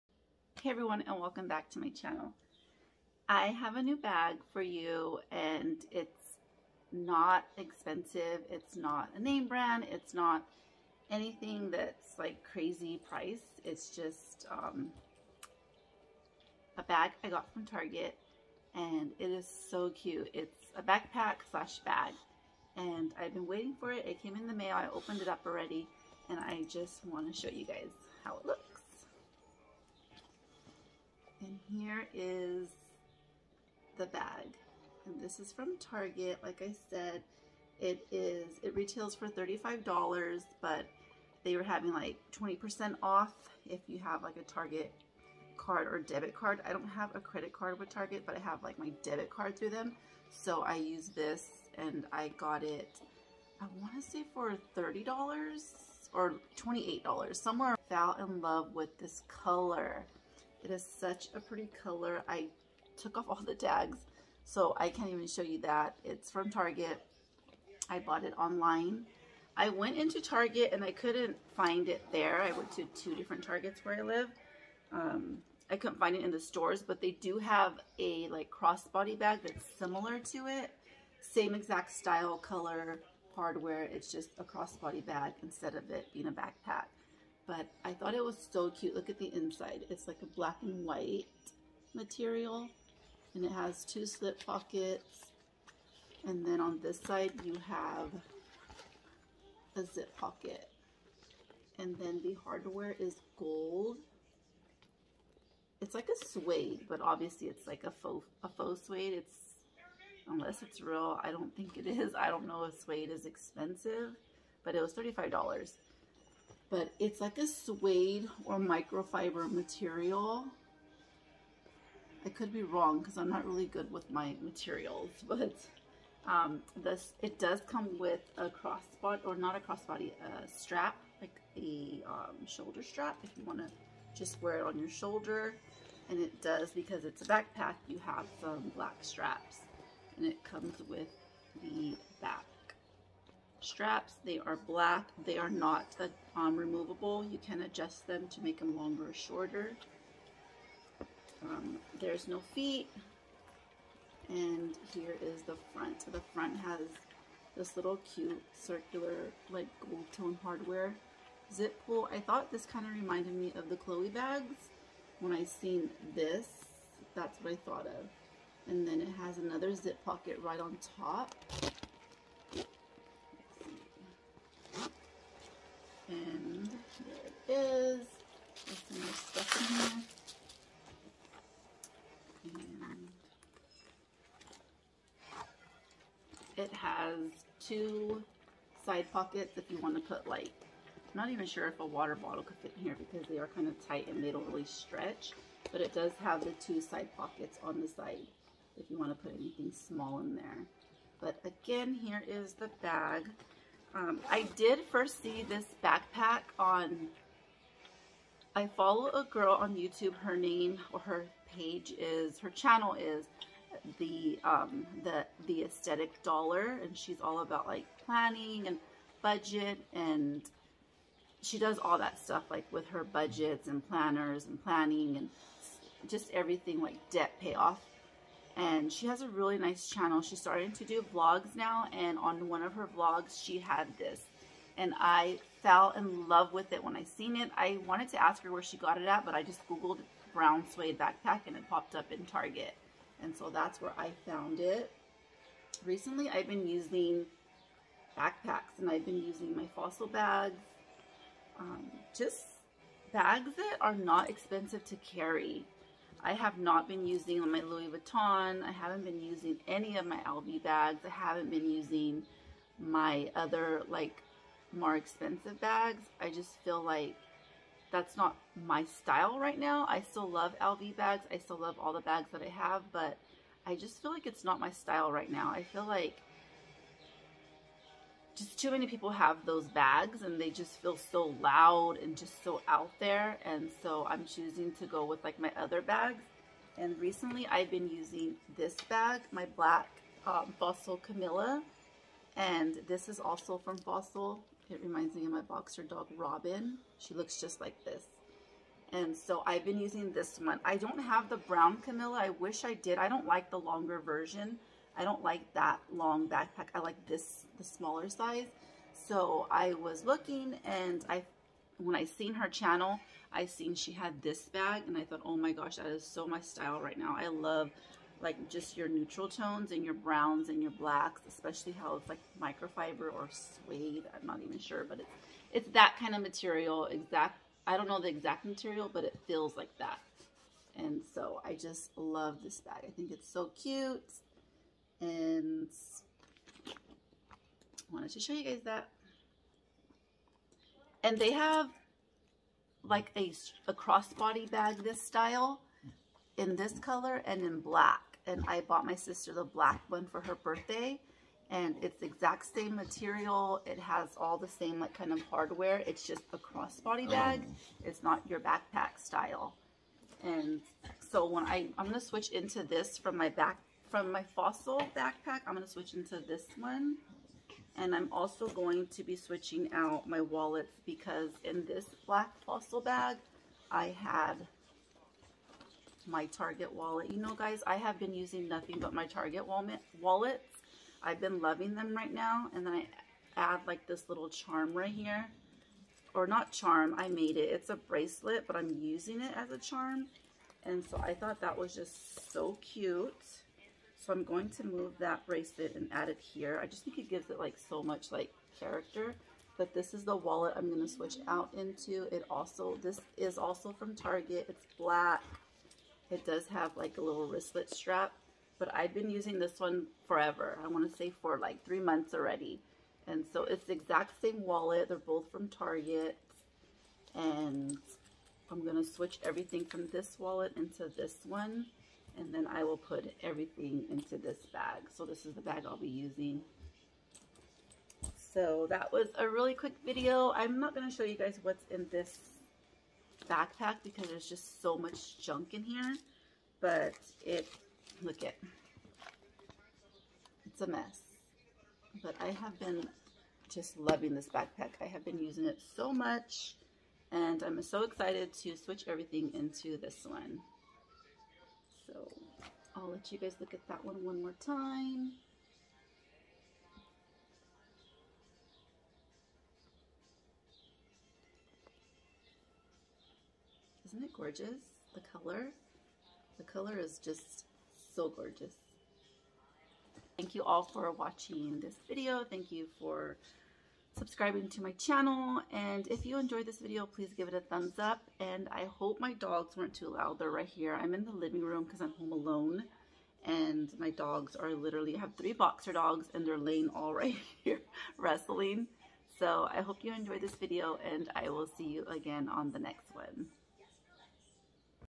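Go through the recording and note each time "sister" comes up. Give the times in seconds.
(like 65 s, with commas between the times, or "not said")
348 s.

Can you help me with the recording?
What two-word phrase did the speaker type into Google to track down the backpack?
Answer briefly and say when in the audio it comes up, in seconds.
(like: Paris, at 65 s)
brown suede backpack, at 240 s.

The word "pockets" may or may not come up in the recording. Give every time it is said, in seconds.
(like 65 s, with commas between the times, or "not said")
94 s, 100 s, 170 s, 189 s, 197 s.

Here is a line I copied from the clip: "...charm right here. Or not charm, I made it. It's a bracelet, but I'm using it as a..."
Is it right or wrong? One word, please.
right.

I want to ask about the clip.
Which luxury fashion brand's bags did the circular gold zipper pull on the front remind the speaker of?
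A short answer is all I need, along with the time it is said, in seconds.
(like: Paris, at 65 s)
Chloe, at 163 s.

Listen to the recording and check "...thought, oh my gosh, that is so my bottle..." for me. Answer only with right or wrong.
wrong.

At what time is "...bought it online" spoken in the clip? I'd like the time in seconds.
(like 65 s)
67 s.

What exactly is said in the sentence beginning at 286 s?
And recently I've been using this bag, my black um, Fossil Camilla.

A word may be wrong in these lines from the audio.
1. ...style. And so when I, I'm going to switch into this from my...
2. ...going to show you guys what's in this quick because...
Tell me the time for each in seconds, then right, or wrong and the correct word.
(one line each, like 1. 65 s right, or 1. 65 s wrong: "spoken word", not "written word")
1. 359 s right
2. 430 s wrong: "backpack", not "quick".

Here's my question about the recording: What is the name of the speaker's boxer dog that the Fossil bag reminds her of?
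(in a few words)
Robin.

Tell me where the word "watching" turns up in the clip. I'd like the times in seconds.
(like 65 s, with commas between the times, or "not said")
470 s.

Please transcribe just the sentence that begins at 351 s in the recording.
And it's the exact same material.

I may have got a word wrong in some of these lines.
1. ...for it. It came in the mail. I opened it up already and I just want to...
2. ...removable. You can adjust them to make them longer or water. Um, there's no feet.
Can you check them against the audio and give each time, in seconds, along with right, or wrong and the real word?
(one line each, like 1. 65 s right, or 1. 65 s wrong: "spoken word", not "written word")
1. 23 s right
2. 146 s wrong: "shorter", not "water".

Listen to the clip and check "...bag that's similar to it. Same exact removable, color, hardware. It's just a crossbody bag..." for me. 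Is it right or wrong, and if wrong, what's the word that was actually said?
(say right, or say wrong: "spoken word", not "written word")
wrong: "style", not "removable".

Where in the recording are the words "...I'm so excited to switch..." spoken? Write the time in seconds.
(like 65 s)
447 s.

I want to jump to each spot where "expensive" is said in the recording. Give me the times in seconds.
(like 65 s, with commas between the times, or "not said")
7 s, 113 s, 254 s, 264 s.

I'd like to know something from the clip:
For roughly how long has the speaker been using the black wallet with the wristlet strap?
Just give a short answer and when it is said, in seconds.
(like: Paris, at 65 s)
3 months, at 411 s.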